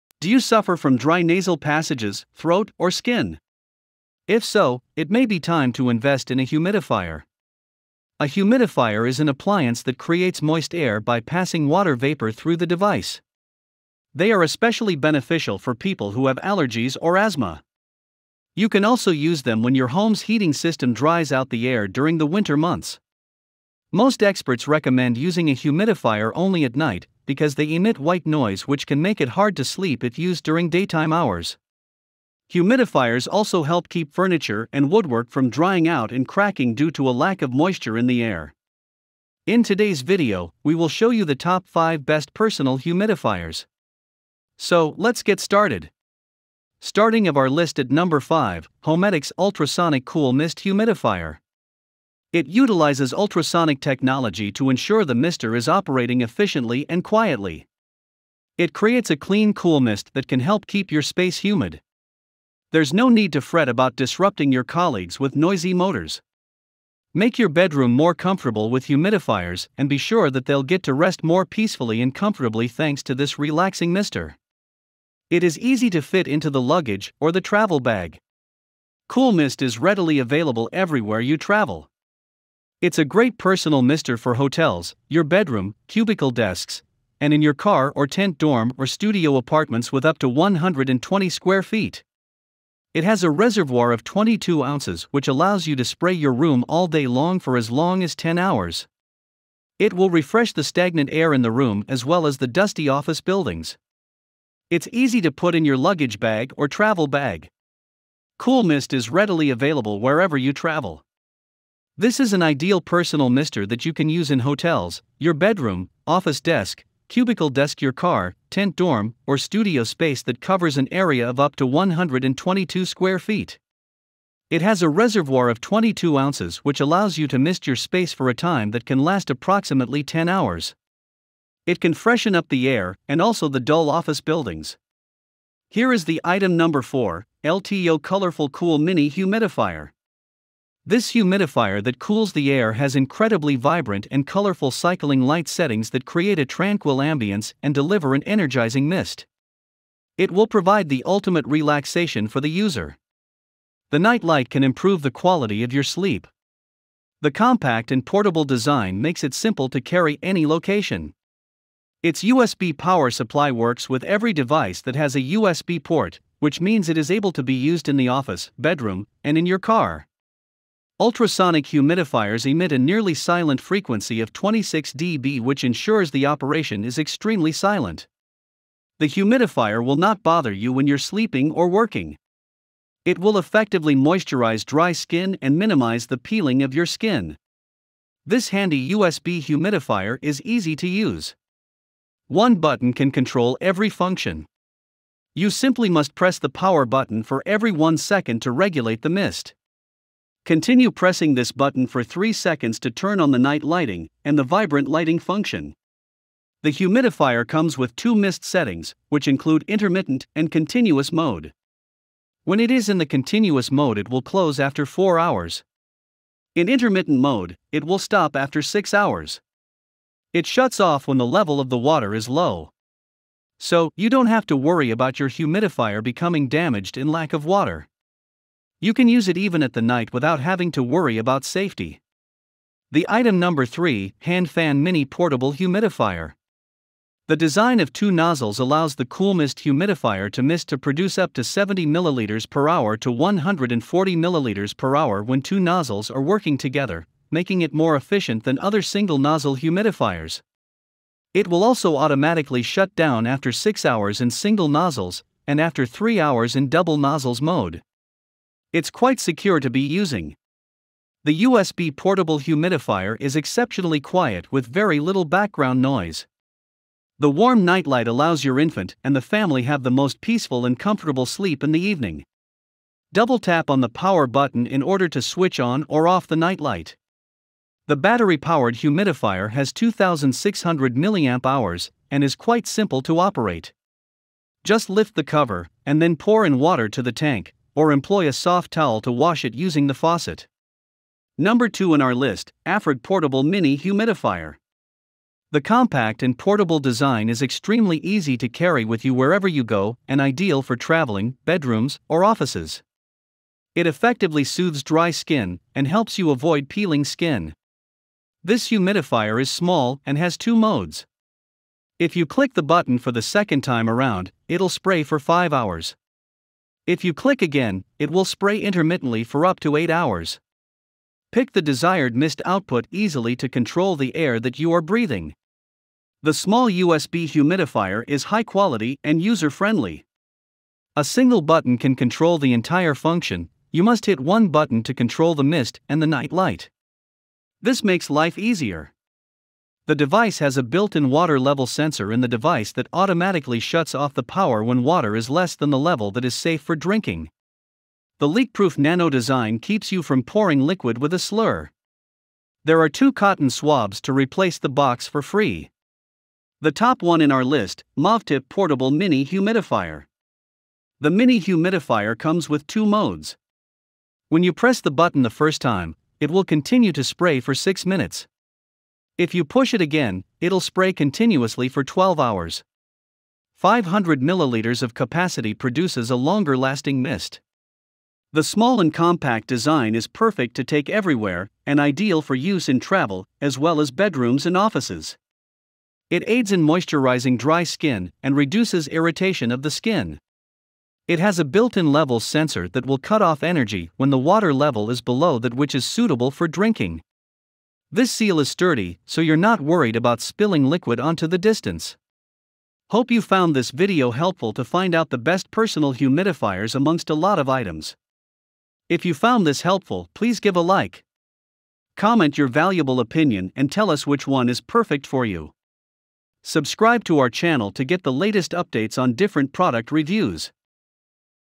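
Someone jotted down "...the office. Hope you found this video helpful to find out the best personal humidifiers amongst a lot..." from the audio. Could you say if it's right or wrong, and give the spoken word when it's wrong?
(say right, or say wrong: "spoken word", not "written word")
wrong: "distance", not "office".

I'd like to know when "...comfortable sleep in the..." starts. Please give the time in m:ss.
4:30.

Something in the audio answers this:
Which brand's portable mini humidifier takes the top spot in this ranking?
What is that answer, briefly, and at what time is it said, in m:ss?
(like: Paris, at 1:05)
MovTip, at 5:57.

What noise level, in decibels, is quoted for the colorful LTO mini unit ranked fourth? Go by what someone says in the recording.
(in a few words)
26 dB.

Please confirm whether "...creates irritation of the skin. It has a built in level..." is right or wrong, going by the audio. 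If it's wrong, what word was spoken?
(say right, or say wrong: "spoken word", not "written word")
wrong: "reduces", not "creates".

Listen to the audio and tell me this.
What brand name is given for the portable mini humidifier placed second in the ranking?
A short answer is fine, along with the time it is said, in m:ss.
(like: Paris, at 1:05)
Afrig, at 4:52.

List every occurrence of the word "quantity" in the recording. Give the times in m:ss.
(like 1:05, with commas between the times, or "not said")
not said.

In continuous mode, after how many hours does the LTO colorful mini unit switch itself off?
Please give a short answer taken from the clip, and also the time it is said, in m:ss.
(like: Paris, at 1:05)
4 hours, at 3:34.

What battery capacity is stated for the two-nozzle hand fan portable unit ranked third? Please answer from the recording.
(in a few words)
2600 mAh.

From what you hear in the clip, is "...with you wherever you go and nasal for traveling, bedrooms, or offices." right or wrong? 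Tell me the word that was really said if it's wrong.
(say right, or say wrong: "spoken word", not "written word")
wrong: "ideal", not "nasal".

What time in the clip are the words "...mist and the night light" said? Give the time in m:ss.
5:35.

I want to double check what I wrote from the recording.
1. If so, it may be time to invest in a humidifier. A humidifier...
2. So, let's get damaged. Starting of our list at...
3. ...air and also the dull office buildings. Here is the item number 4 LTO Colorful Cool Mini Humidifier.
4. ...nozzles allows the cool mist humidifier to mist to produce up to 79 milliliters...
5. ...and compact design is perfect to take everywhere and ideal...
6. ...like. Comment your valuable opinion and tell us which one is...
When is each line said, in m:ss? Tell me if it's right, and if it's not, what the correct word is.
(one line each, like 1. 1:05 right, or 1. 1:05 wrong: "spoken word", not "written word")
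1. 0:04 right
2. 0:44 wrong: "started", not "damaged"
3. 2:12 right
4. 3:58 wrong: "70", not "79"
5. 6:18 right
6. 6:50 right.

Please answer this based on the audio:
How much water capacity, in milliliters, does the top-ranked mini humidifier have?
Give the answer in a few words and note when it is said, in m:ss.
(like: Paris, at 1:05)
500 milliliters, at 6:13.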